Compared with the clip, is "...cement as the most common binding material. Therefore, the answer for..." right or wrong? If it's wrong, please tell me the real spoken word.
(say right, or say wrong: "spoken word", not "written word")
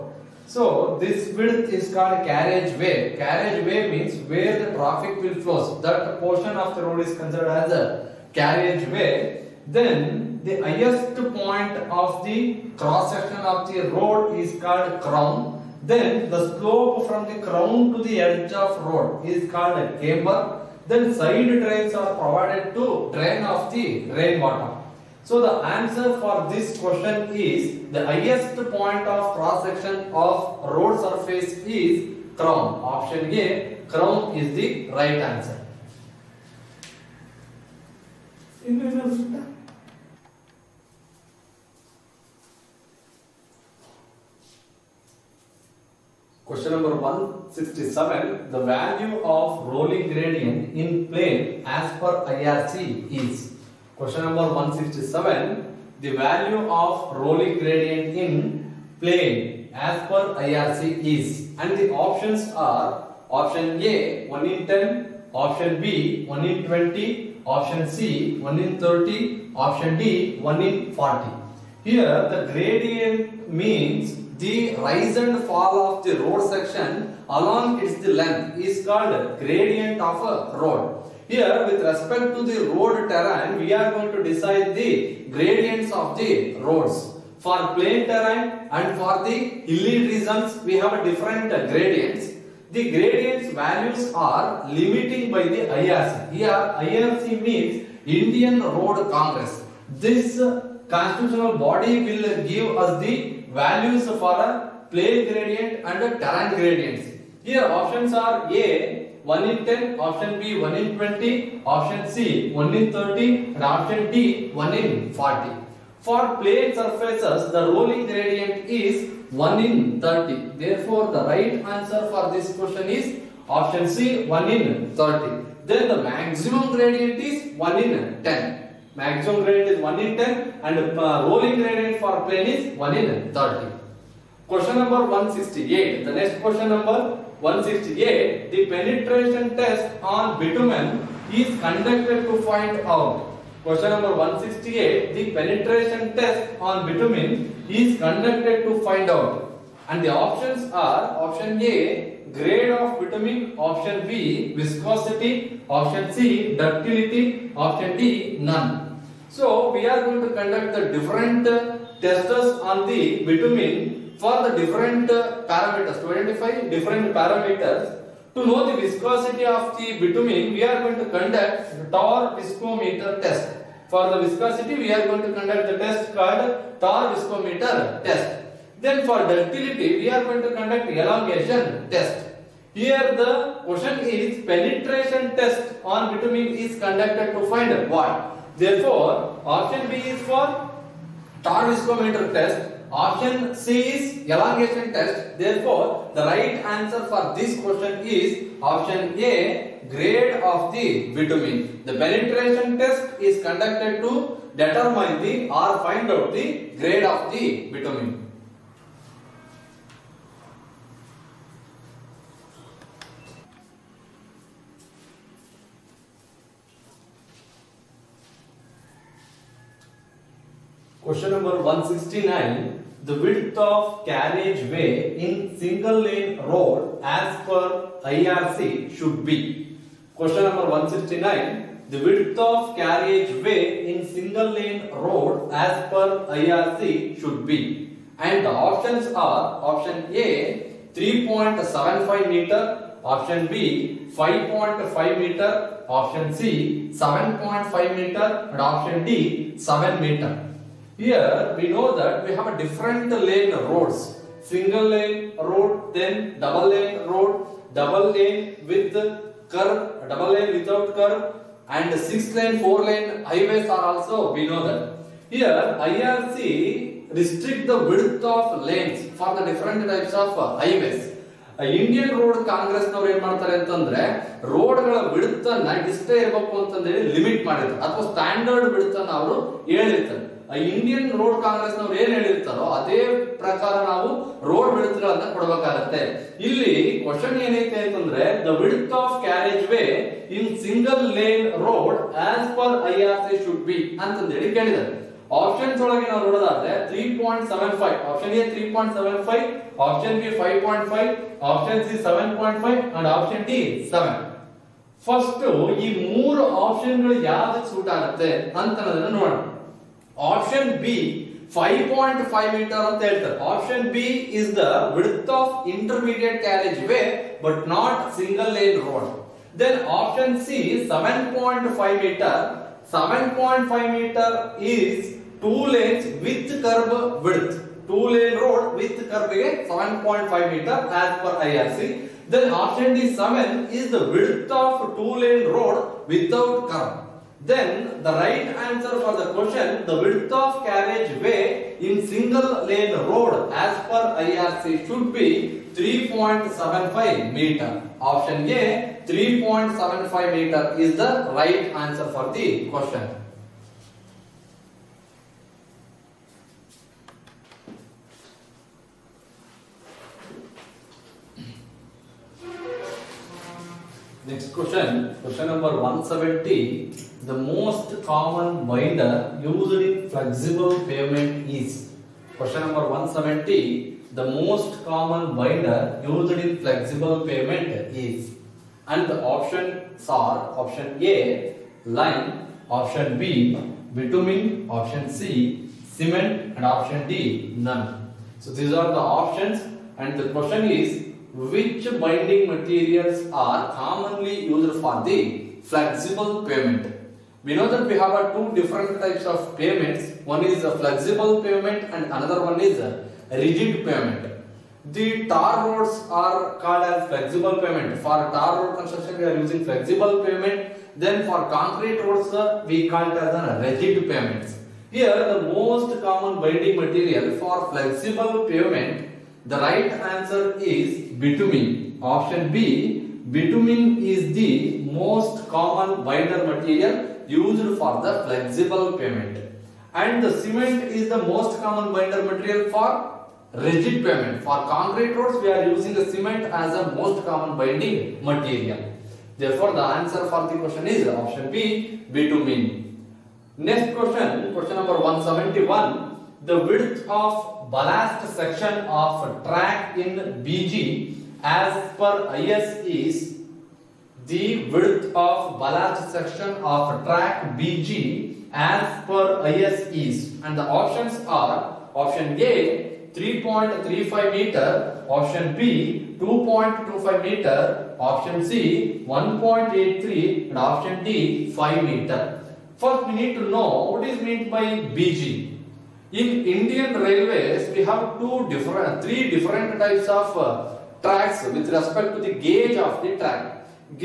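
right.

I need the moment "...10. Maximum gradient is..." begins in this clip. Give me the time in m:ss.
2:08.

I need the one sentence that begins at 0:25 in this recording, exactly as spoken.
So the answer for this question is the highest point of cross section of road surface is crown.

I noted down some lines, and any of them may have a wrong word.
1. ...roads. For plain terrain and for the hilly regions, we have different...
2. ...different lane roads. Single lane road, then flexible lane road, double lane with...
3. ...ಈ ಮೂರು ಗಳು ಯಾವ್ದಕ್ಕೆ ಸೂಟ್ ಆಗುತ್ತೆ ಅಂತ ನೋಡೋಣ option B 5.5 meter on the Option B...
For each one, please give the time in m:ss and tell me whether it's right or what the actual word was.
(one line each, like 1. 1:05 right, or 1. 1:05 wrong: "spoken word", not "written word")
1. 1:26 right
2. 4:12 wrong: "double", not "flexible"
3. 5:05 right.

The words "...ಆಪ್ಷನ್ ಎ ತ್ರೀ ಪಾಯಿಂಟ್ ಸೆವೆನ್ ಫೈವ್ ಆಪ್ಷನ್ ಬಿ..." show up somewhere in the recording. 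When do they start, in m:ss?
4:58.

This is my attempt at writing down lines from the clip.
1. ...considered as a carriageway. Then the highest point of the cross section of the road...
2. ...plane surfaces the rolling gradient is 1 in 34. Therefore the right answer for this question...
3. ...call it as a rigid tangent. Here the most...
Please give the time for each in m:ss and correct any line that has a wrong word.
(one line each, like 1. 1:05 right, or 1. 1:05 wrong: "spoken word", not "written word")
1. 0:07 right
2. 1:56 wrong: "30", not "34"
3. 6:52 wrong: "pavement", not "tangent".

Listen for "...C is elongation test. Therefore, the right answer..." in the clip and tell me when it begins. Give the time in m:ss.
3:13.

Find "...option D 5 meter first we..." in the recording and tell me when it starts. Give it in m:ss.
7:50.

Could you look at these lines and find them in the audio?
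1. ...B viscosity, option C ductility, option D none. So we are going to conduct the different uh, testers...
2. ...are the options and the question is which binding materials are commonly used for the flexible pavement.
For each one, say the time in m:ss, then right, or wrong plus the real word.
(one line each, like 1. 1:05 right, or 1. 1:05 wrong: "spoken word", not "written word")
1. 2:34 right
2. 6:28 right.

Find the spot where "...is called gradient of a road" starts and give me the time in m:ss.
1:18.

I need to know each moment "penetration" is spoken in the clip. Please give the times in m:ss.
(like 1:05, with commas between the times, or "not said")
2:18, 2:25, 3:04, 3:22.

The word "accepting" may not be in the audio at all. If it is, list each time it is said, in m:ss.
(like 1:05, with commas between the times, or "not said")
not said.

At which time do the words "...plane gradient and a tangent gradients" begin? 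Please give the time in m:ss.
1:44.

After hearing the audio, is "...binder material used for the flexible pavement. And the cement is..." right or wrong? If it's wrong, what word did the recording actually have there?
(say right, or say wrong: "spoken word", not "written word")
right.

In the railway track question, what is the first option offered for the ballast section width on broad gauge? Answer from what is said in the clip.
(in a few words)
3.35 meters.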